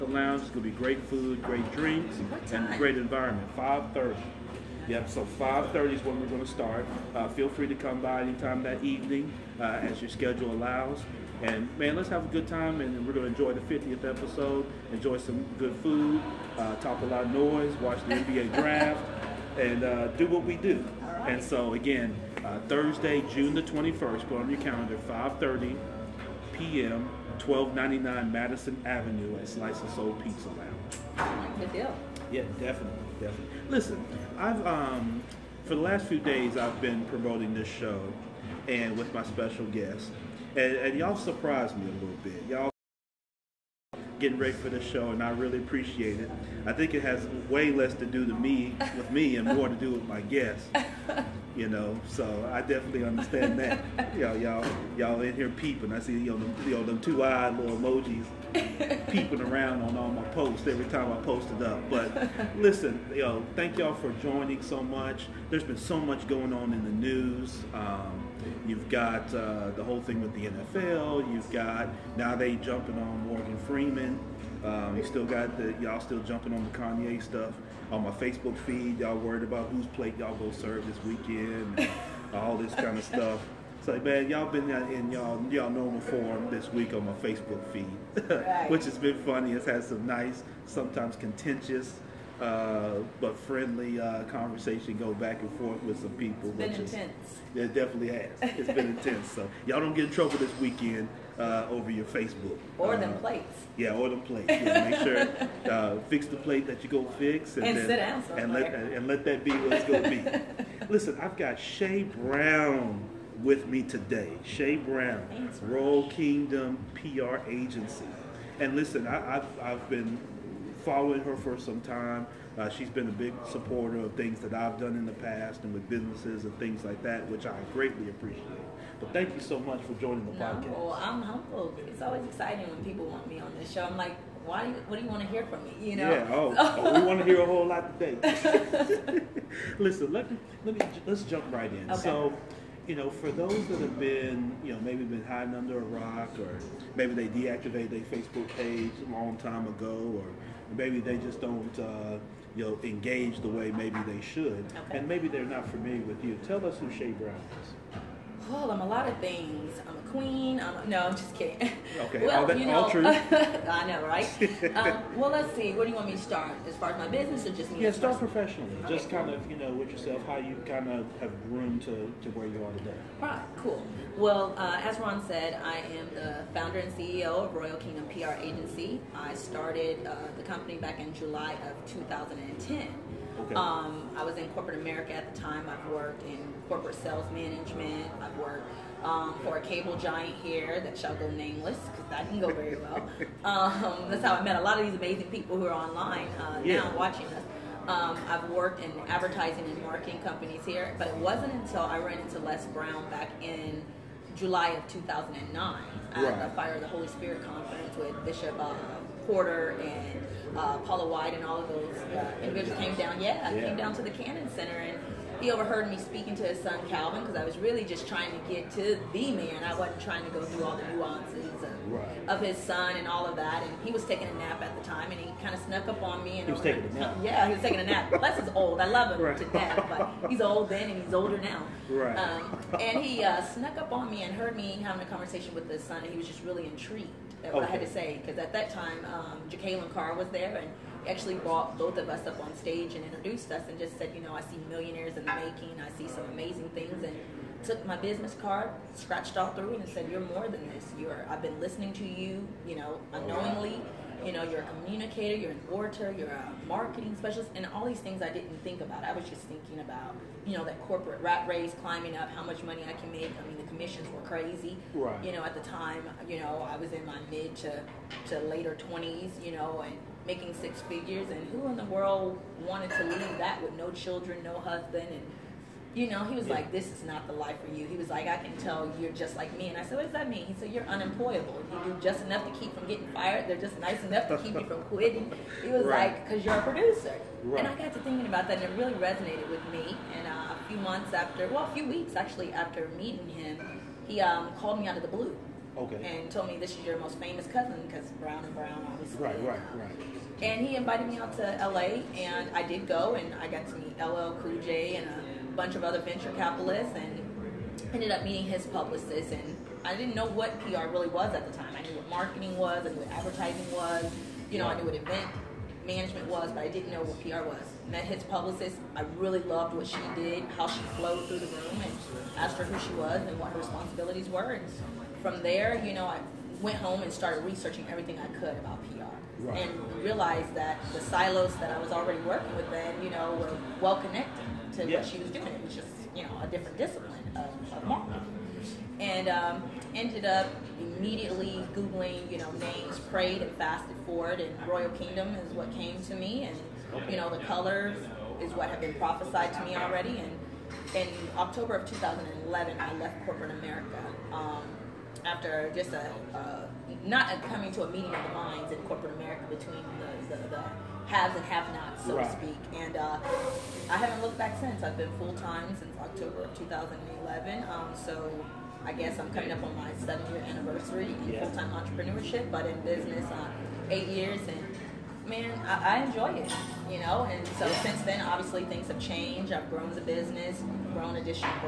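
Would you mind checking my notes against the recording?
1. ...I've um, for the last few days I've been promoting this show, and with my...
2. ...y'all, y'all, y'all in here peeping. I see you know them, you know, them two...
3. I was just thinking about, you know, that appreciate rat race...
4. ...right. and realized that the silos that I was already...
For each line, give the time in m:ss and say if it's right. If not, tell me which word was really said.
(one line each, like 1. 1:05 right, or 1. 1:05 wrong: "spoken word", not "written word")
1. 0:34 right
2. 0:54 right
3. 4:19 wrong: "corporate", not "appreciate"
4. 5:29 right.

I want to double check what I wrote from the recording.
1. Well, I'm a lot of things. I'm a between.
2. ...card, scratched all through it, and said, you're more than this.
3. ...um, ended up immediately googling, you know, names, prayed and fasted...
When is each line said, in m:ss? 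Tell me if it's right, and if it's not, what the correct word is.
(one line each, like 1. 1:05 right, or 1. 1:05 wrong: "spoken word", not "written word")
1. 2:38 wrong: "queen", not "between"
2. 4:08 right
3. 5:39 right.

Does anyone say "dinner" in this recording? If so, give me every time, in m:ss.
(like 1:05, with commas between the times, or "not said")
not said.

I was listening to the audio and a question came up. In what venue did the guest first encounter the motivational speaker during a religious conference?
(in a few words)
Cannon Center.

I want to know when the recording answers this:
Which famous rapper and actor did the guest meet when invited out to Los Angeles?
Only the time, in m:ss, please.
5:03.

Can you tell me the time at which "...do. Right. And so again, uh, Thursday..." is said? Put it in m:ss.
0:20.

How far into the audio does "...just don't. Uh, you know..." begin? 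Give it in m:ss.
2:31.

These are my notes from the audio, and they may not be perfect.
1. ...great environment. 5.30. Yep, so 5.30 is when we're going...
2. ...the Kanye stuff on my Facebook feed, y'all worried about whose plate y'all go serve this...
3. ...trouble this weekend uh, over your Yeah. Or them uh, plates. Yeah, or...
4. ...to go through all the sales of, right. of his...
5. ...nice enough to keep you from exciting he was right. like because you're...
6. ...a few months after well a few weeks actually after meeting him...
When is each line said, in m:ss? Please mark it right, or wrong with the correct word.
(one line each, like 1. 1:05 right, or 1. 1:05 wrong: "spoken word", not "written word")
1. 0:02 right
2. 1:16 right
3. 1:40 wrong: "Facebook", not "Yeah"
4. 3:40 wrong: "nuances", not "sales"
5. 4:43 wrong: "quitting", not "exciting"
6. 4:50 right.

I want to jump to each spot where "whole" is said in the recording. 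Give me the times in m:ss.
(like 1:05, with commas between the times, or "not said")
1:09, 2:17.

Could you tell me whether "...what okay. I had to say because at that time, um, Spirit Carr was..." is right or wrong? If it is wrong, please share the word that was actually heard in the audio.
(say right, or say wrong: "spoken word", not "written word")
wrong: "Jacqueline", not "Spirit".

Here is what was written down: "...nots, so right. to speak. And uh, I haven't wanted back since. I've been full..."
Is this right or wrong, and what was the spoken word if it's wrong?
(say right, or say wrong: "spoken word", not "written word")
wrong: "looked", not "wanted".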